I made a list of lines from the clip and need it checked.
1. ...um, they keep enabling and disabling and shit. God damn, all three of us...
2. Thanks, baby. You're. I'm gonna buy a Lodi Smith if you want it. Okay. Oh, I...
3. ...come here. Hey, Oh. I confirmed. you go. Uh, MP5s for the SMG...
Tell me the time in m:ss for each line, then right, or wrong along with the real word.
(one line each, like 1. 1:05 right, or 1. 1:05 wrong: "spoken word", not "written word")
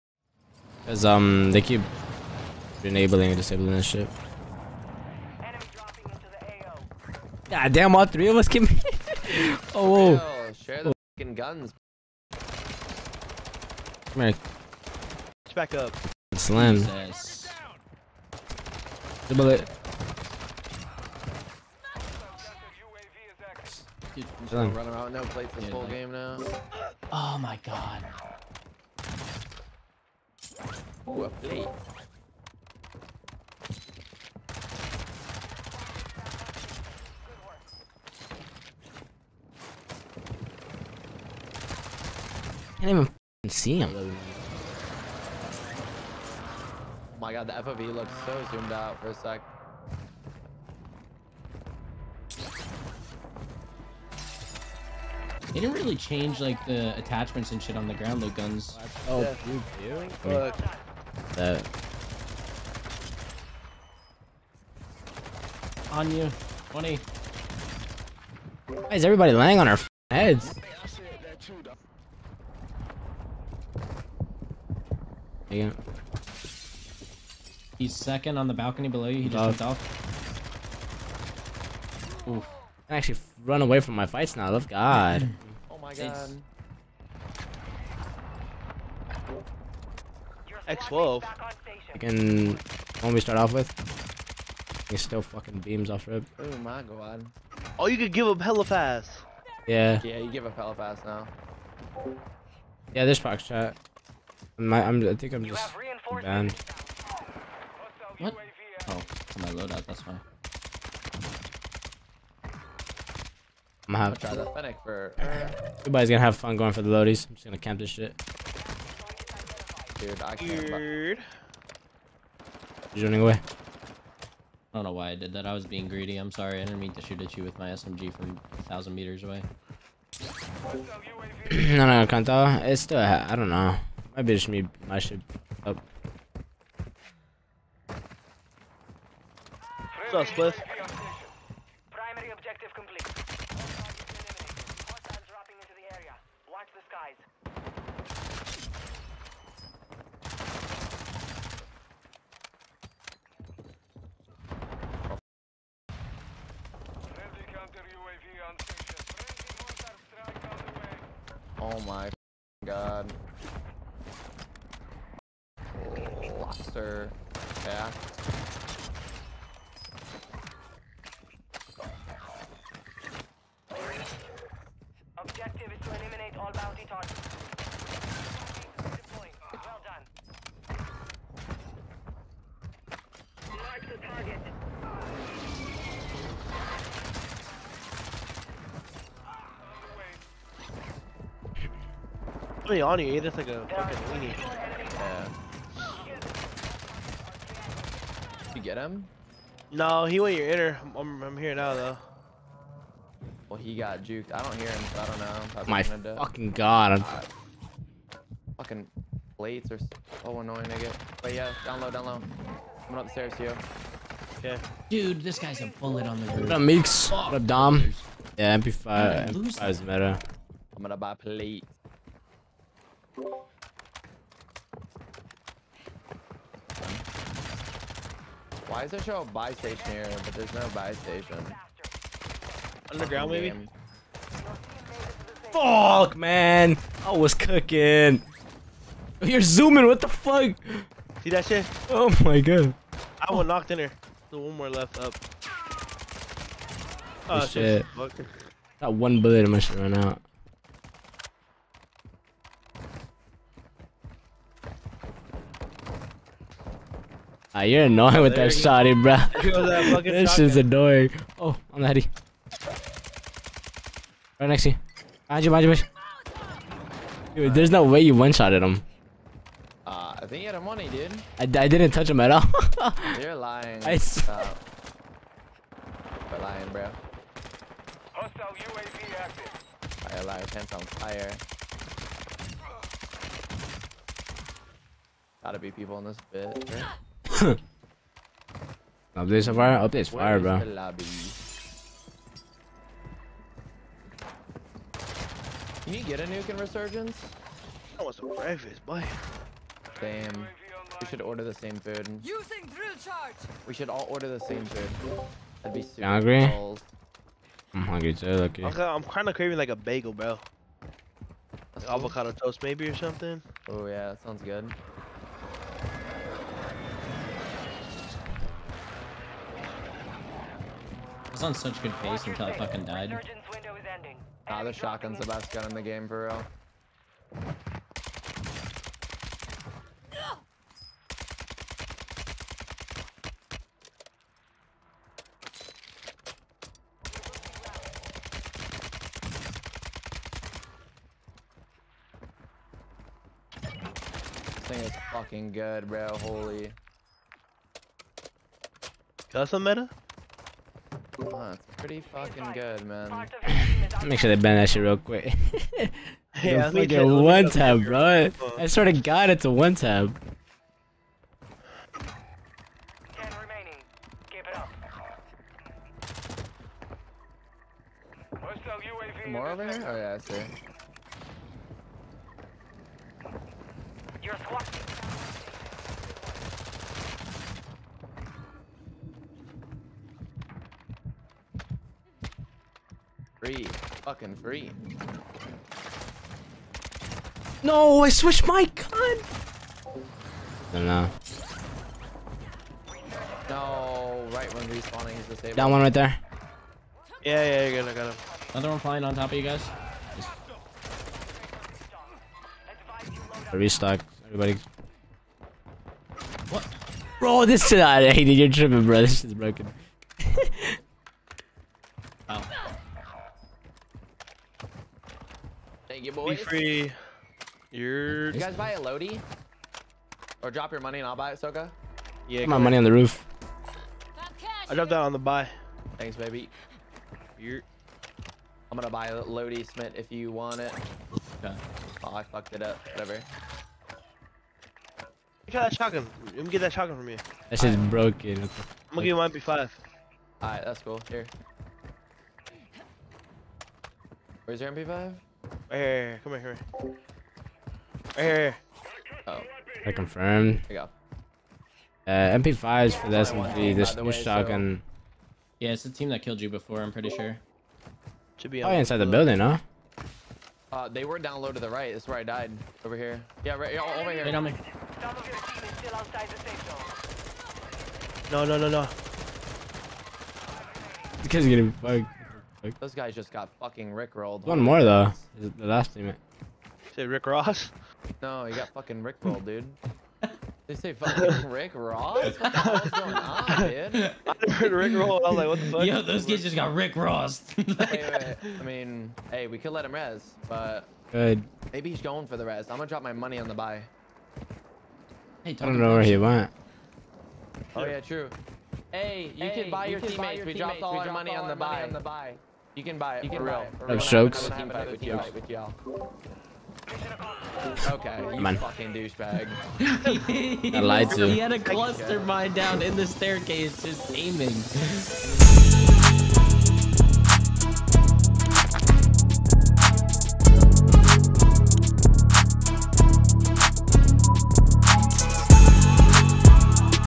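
1. 0:01 right
2. 7:05 right
3. 7:26 right.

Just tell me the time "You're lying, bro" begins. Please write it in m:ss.
4:36.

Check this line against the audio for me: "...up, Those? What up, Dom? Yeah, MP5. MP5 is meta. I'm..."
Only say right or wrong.
wrong.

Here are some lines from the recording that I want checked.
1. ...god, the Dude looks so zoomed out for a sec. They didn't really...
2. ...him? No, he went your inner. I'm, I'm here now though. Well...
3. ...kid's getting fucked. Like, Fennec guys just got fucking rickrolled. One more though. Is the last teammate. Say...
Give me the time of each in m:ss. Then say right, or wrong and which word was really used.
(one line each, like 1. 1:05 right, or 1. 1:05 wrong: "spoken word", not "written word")
1. 0:47 wrong: "FOV", not "Dude"
2. 3:18 right
3. 7:51 wrong: "Those", not "Fennec".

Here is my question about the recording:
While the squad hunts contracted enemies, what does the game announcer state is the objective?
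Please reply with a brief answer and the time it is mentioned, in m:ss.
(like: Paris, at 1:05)
eliminate all bounty targets, at 2:55.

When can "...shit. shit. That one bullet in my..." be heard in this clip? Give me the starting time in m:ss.
4:07.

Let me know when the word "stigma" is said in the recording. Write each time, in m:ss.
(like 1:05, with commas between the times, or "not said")
not said.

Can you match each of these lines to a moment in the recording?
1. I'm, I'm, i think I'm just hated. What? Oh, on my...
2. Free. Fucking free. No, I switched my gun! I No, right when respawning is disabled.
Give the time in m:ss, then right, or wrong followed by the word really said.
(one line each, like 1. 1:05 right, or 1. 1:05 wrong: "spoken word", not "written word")
1. 1:44 wrong: "banned", not "hated"
2. 6:23 right.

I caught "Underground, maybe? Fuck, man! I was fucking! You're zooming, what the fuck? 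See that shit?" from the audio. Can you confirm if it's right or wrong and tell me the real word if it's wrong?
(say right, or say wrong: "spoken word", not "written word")
wrong: "cooking", not "fucking".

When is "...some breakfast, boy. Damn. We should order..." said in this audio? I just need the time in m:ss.
4:58.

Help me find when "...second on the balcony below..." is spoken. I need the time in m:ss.
1:17.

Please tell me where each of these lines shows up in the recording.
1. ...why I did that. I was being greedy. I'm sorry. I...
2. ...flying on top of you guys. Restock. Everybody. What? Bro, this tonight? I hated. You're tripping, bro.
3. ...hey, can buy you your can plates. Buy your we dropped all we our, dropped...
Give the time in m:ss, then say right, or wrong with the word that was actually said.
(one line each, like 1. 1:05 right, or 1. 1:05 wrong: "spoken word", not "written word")
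1. 2:04 right
2. 6:38 right
3. 8:19 wrong: "teammates", not "plates".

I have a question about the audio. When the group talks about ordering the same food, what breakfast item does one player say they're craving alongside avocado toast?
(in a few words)
bagel.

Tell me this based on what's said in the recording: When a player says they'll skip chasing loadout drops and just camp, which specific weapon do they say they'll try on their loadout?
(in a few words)
Fennec.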